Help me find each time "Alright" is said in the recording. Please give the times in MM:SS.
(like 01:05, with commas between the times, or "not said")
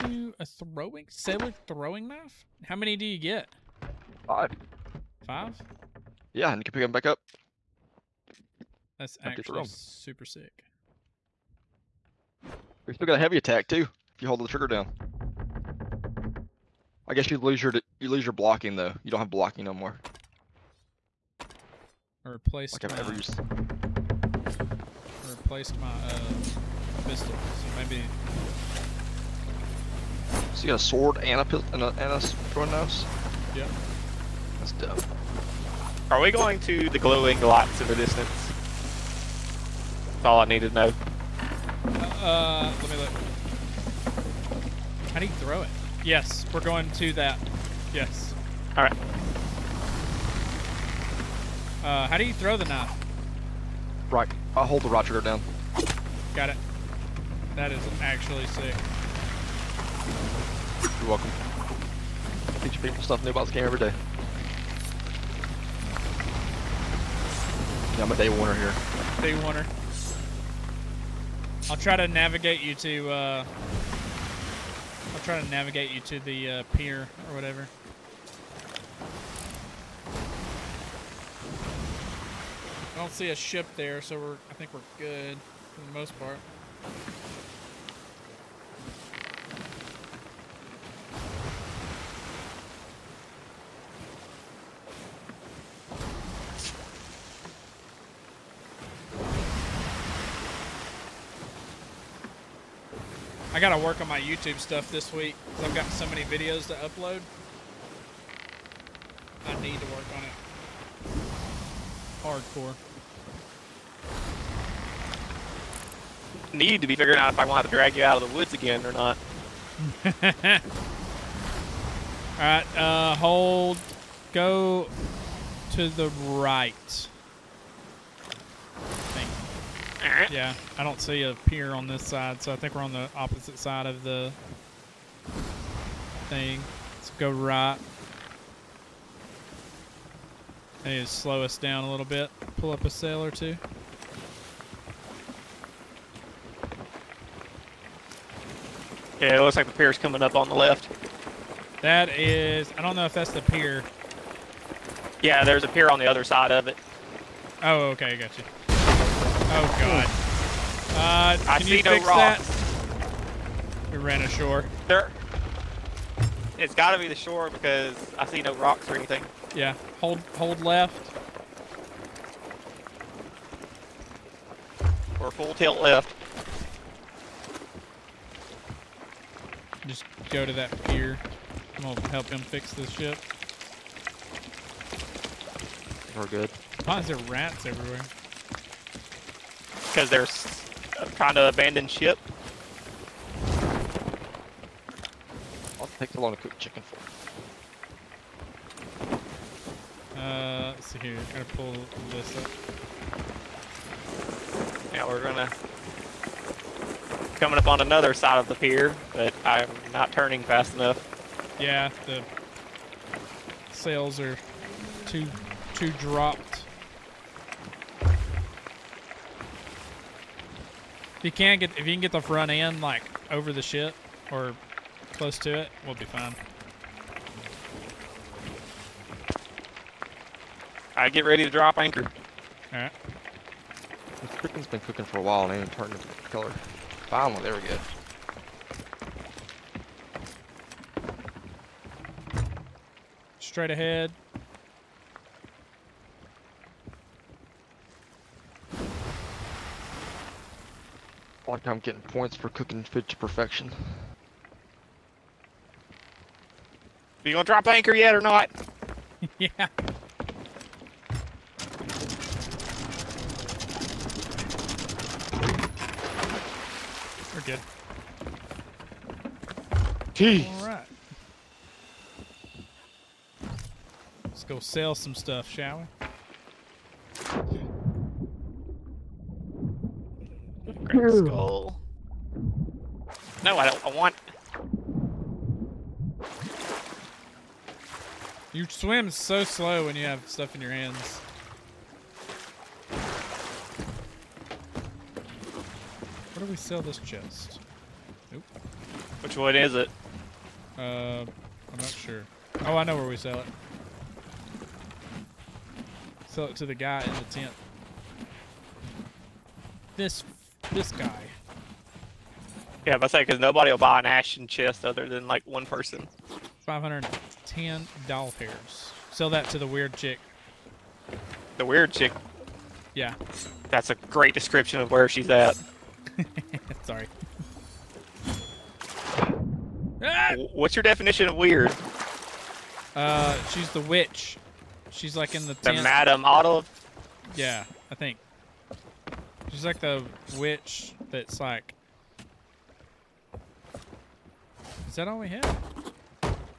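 02:02, 03:52.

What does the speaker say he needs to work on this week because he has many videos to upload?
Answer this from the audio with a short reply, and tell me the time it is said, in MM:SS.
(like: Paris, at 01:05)
YouTube stuff, at 01:44.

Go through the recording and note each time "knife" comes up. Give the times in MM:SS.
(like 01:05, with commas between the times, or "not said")
00:02, 00:32, 00:52.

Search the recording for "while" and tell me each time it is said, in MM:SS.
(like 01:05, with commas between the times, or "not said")
03:55.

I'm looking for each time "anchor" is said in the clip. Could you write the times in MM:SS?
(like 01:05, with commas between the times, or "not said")
03:51, 04:17.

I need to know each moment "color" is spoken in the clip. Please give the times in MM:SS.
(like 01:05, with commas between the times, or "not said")
03:56.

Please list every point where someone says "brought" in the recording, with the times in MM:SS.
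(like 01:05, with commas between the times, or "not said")
not said.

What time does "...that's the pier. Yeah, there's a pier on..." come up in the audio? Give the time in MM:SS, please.
02:33.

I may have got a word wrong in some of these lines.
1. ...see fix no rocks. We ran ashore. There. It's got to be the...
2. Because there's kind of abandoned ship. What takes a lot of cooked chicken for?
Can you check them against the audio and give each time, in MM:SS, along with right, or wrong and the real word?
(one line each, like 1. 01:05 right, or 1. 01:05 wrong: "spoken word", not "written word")
1. 02:41 right
2. 03:09 right.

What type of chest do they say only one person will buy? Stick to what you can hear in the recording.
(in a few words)
ashen chest.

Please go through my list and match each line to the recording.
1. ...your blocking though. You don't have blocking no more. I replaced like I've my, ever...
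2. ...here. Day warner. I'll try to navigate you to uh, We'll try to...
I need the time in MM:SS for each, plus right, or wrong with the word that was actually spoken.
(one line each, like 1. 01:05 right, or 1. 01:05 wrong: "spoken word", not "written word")
1. 00:18 right
2. 01:08 right.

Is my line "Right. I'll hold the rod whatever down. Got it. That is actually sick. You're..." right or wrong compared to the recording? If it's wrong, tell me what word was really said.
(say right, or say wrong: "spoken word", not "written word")
wrong: "trigger", not "whatever".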